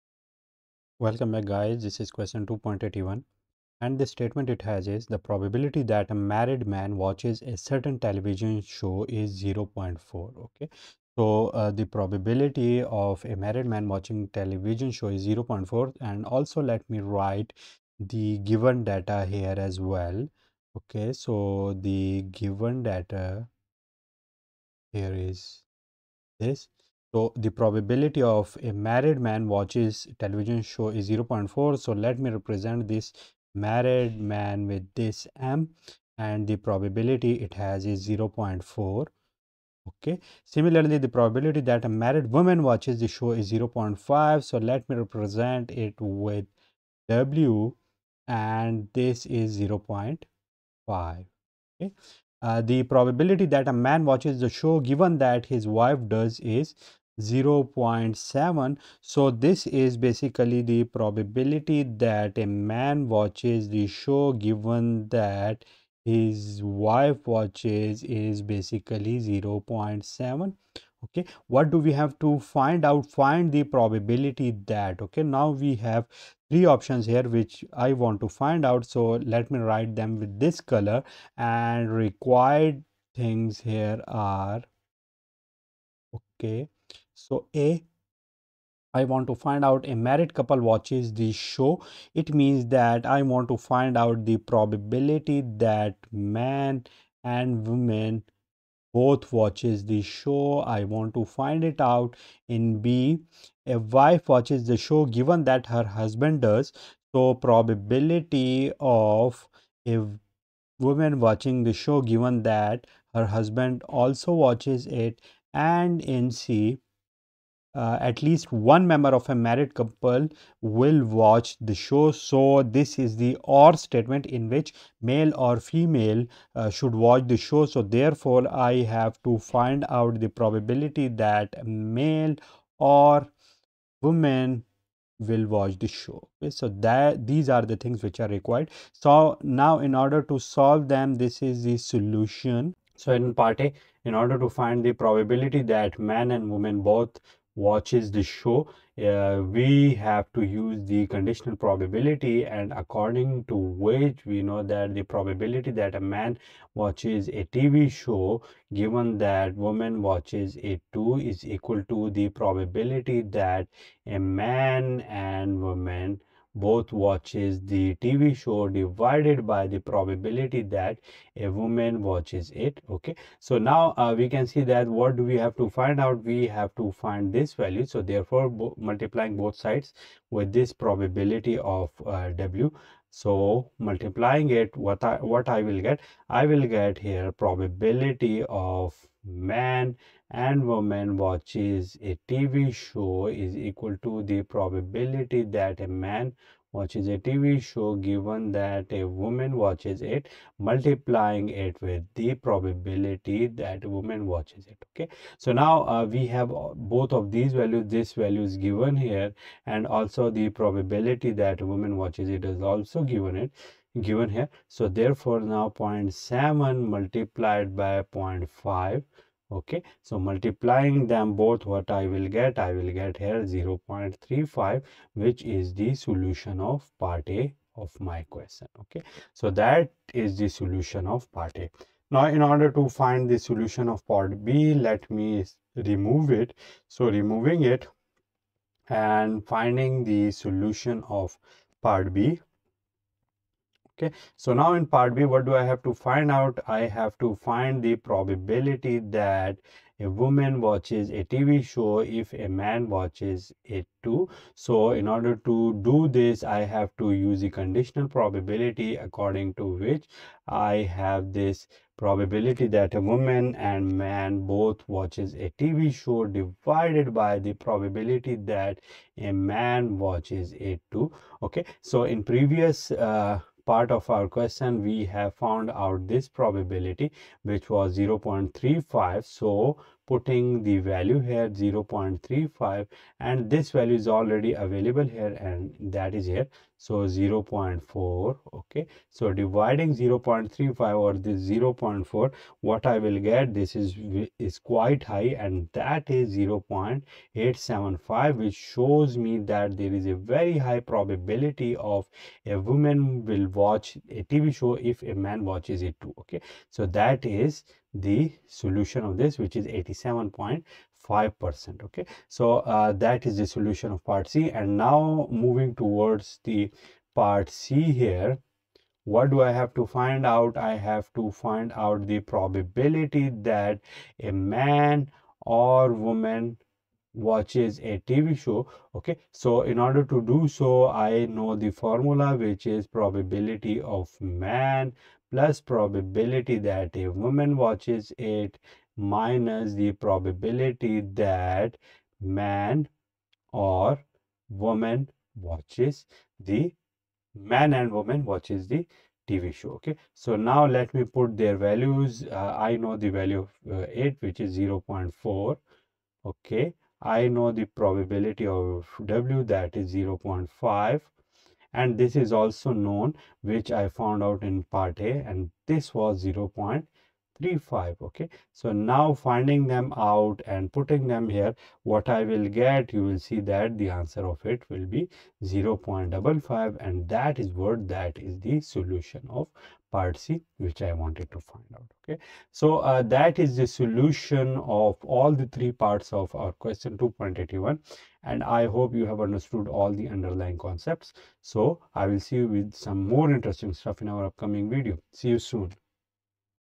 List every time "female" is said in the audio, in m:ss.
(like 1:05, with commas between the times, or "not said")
2:05.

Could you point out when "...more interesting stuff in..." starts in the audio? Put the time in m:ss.
6:33.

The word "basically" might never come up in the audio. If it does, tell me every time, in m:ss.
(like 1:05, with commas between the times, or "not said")
0:59, 1:08.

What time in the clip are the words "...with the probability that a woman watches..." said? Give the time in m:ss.
3:21.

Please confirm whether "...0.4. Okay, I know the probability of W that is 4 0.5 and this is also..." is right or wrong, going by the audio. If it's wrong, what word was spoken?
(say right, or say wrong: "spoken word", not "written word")
wrong: "0", not "4".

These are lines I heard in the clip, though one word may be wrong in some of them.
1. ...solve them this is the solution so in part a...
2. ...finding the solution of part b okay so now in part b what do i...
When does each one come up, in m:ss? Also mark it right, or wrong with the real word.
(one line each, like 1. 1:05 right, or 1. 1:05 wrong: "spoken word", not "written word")
1. 2:20 right
2. 3:59 right.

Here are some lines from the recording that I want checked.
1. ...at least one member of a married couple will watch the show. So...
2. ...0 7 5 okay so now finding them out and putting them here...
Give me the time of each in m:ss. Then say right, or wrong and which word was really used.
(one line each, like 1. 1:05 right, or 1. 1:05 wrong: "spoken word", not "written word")
1. 1:58 right
2. 6:06 wrong: "3", not "7".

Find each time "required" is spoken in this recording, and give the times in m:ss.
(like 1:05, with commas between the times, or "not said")
1:21, 2:18.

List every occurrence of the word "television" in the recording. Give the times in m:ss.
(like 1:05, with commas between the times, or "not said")
0:07, 0:14, 0:30.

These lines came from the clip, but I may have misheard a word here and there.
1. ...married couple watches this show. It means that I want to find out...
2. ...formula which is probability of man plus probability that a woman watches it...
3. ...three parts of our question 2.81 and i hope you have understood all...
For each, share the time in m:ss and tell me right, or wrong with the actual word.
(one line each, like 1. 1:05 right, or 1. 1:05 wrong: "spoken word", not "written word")
1. 1:29 right
2. 5:31 right
3. 6:25 right.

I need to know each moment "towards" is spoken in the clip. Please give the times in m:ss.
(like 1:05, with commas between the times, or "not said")
5:15.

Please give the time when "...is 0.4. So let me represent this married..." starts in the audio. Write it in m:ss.
0:30.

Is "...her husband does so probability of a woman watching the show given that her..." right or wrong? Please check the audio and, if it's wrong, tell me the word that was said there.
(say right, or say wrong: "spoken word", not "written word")
right.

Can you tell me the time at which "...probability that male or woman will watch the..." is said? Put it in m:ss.
2:10.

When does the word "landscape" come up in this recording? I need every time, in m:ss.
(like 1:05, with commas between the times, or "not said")
not said.